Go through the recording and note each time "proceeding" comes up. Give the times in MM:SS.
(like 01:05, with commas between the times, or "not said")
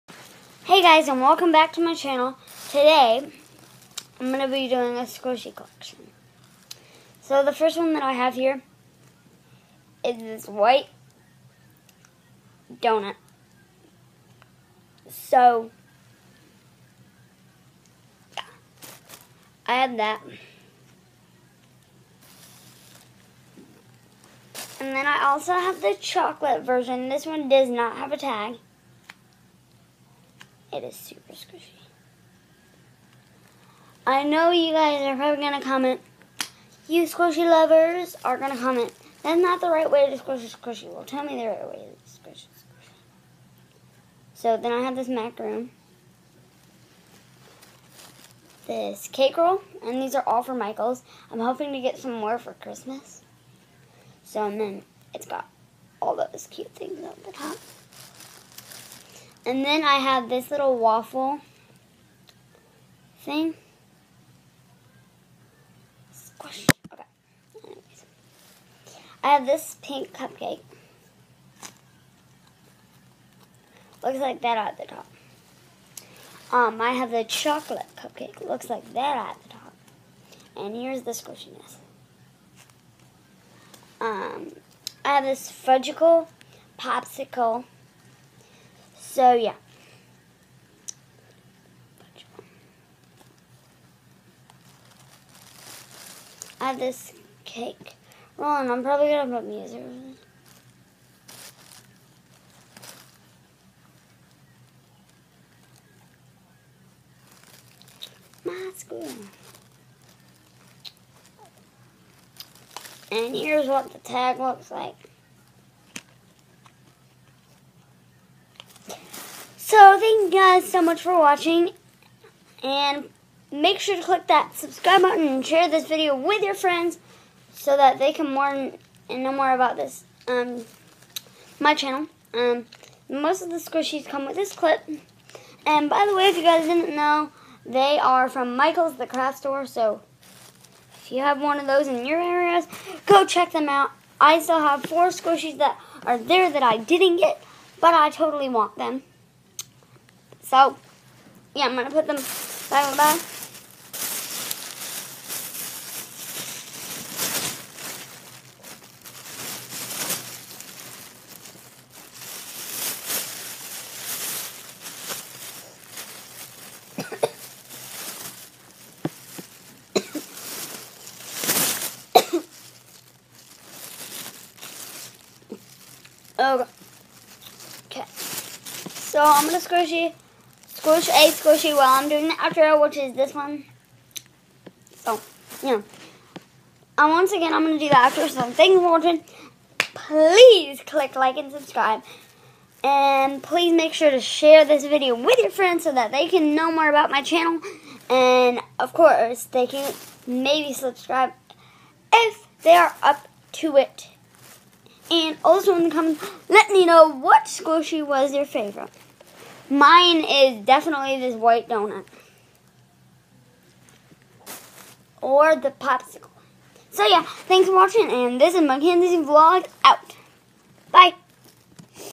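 not said.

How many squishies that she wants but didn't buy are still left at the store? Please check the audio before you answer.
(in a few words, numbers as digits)
4.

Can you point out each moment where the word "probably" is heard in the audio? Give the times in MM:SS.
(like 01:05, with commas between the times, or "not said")
00:35, 01:38.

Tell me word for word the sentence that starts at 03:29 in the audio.
Mine is definitely this white donut.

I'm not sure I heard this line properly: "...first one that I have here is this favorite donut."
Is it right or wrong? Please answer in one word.
wrong.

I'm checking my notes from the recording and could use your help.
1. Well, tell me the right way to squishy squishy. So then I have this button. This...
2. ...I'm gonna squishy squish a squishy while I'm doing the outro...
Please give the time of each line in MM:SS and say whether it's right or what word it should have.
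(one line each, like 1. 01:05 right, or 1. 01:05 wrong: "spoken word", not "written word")
1. 00:40 wrong: "macaroon", not "button"
2. 02:59 right.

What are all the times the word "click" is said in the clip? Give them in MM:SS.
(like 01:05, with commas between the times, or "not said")
02:04, 03:10.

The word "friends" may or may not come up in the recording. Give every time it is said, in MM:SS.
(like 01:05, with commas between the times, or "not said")
02:06, 03:15.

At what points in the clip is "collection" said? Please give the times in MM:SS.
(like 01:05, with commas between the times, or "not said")
00:05.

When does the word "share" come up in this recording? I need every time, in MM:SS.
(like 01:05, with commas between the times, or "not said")
02:05, 03:14.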